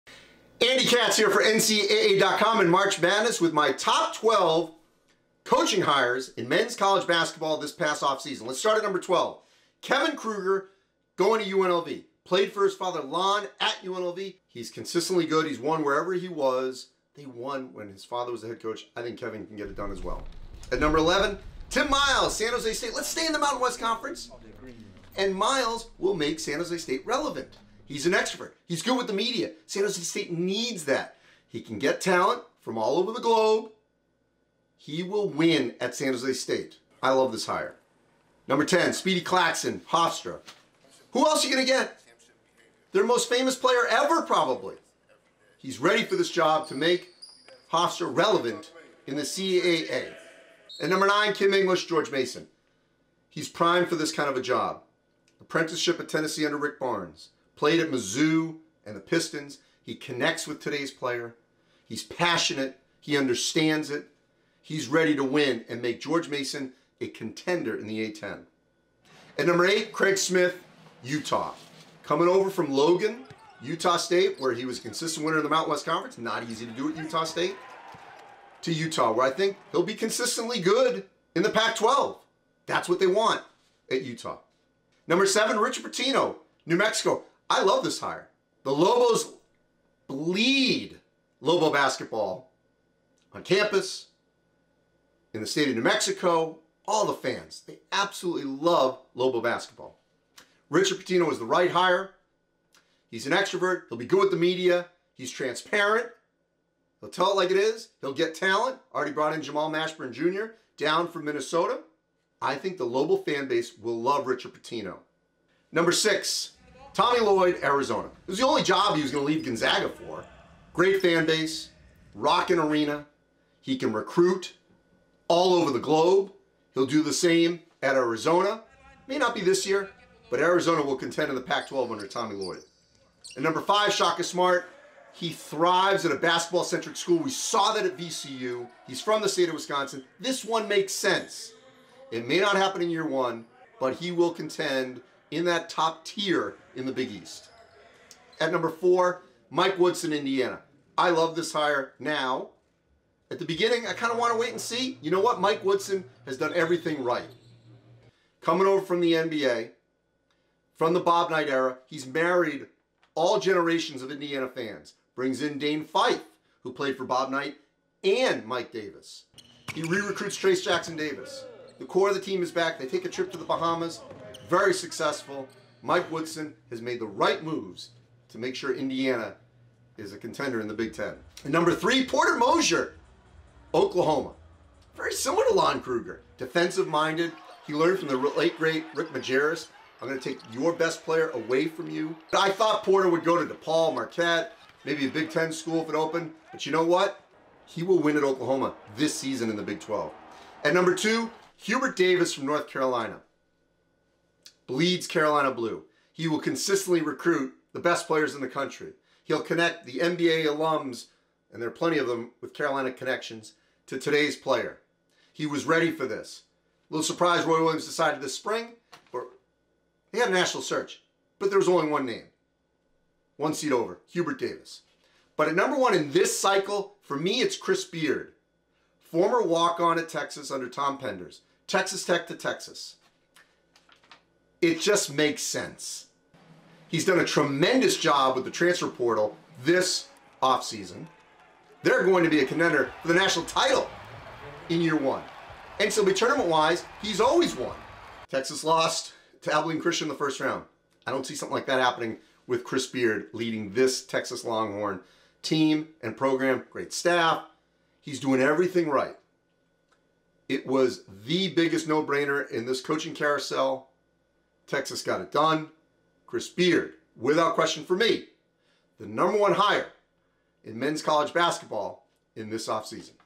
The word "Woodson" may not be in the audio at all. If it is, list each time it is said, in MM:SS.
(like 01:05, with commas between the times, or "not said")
02:29, 02:35, 02:56.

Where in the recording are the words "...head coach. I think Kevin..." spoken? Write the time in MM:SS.
00:18.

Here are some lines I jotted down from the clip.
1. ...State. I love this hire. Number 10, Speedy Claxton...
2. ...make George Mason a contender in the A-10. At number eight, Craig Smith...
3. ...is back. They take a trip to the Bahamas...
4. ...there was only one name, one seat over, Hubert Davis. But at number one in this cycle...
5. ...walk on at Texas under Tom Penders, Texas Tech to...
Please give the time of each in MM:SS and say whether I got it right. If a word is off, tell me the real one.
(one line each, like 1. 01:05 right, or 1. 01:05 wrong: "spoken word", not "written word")
1. 00:36 right
2. 01:05 right
3. 02:52 right
4. 03:41 right
5. 03:49 right.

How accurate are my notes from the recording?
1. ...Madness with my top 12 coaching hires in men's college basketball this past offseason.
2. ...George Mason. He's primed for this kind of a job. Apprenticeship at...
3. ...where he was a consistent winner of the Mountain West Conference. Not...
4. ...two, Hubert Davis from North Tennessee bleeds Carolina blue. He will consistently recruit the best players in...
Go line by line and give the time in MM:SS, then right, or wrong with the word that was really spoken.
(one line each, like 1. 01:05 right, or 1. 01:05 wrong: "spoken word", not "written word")
1. 00:03 right
2. 00:51 right
3. 01:14 right
4. 03:20 wrong: "Carolina", not "Tennessee".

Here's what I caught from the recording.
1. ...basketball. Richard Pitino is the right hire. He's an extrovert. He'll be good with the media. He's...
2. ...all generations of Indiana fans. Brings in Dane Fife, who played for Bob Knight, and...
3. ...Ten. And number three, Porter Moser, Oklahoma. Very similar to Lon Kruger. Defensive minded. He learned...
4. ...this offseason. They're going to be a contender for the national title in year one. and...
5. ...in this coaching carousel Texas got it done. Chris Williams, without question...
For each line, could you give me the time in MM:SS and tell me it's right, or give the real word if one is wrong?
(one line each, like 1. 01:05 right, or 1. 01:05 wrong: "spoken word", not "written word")
1. 01:39 right
2. 02:43 right
3. 03:00 right
4. 03:59 right
5. 04:22 wrong: "Beard", not "Williams".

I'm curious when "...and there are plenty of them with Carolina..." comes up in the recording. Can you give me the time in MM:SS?
03:31.